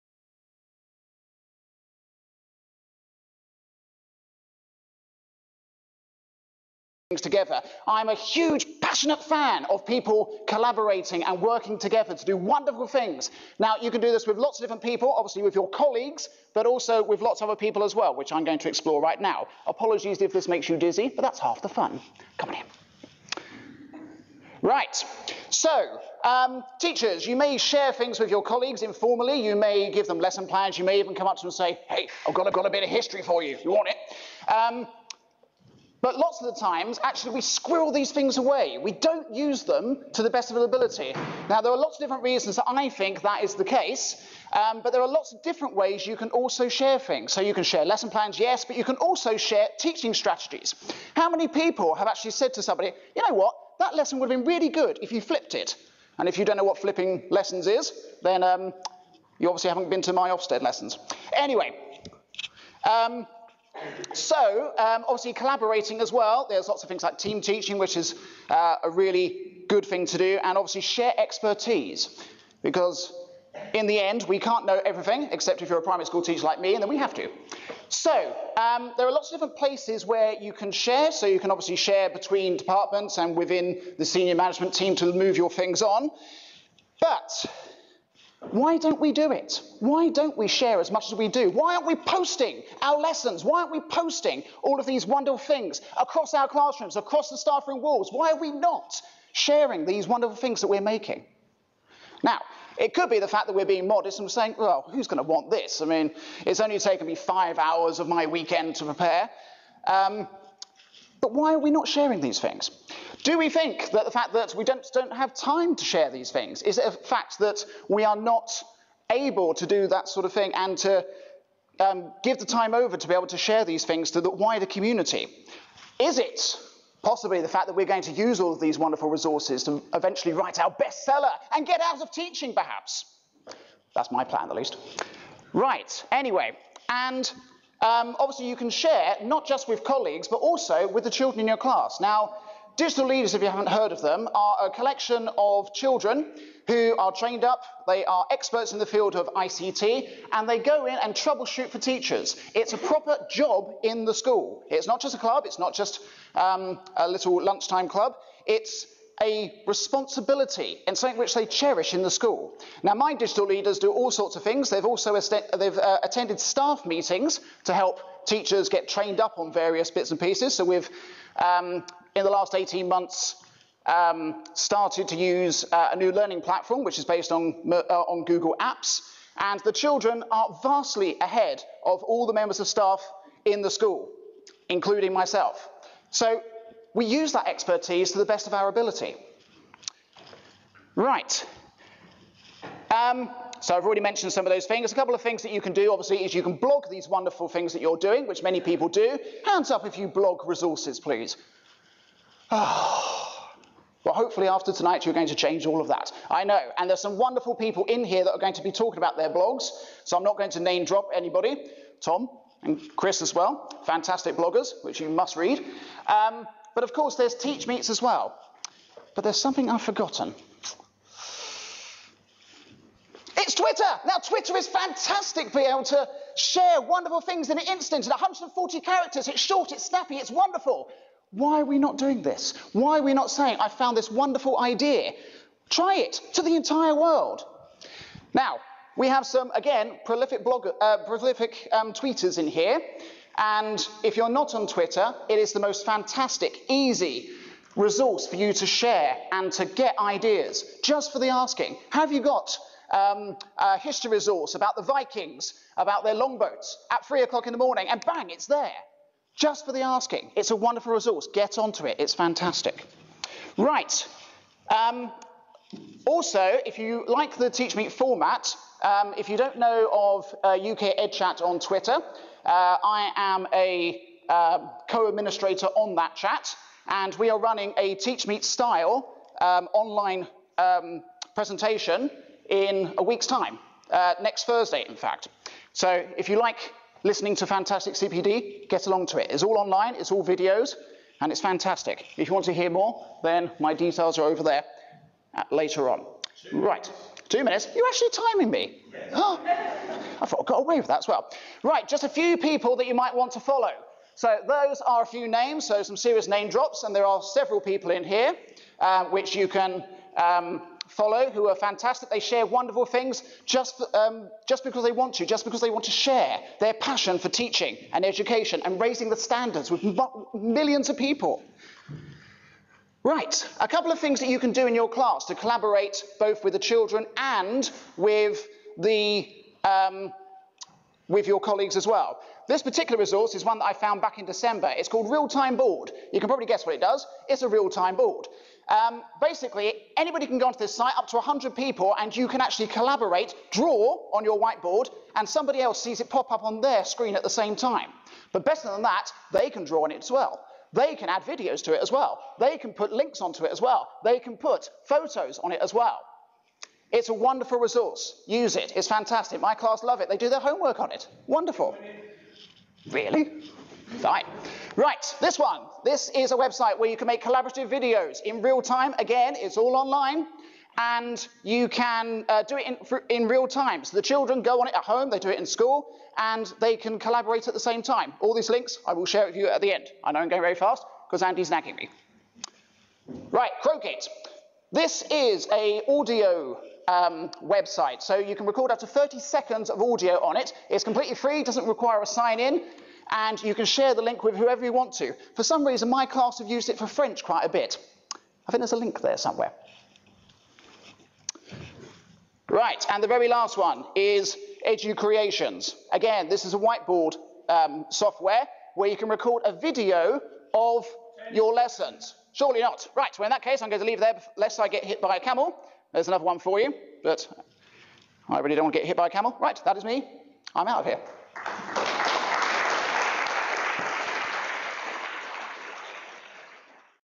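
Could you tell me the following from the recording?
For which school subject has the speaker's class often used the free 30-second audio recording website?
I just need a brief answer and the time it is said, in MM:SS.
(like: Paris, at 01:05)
French, at 06:36.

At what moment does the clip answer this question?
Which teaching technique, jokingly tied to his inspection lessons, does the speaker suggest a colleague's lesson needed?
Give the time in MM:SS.
00:55.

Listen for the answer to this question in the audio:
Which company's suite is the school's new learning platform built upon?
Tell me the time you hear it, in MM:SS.
02:58.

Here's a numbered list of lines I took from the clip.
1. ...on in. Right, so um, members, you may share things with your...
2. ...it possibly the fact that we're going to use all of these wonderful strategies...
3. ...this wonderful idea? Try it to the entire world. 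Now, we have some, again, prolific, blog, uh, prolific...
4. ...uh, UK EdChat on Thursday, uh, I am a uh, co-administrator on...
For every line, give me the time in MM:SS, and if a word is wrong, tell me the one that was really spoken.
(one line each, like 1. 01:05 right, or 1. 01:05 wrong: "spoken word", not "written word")
1. 00:22 wrong: "teachers", not "members"
2. 02:06 wrong: "resources", not "strategies"
3. 03:53 right
4. 04:30 wrong: "Twitter", not "Thursday".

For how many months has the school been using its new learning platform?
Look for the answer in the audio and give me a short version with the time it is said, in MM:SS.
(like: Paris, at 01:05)
18, at 02:52.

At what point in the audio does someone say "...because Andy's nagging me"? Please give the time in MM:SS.
06:21.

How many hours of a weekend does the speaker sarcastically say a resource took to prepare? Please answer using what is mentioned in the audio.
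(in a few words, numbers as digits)
5.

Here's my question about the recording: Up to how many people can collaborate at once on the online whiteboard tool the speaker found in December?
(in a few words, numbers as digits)
100.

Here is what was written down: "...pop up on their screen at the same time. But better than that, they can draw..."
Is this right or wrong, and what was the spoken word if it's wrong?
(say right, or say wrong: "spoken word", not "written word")
right.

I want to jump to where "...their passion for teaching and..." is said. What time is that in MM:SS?
05:16.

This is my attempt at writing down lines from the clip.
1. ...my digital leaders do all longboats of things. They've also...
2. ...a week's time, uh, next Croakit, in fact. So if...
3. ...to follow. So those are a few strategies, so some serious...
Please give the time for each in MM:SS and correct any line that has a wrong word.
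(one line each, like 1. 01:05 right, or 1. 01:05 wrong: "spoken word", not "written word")
1. 02:42 wrong: "sorts", not "longboats"
2. 04:42 wrong: "Thursday", not "Croakit"
3. 05:03 wrong: "names", not "strategies".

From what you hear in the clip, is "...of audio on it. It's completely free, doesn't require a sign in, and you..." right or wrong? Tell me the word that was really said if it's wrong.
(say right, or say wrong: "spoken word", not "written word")
right.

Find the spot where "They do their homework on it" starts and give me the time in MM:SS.
06:00.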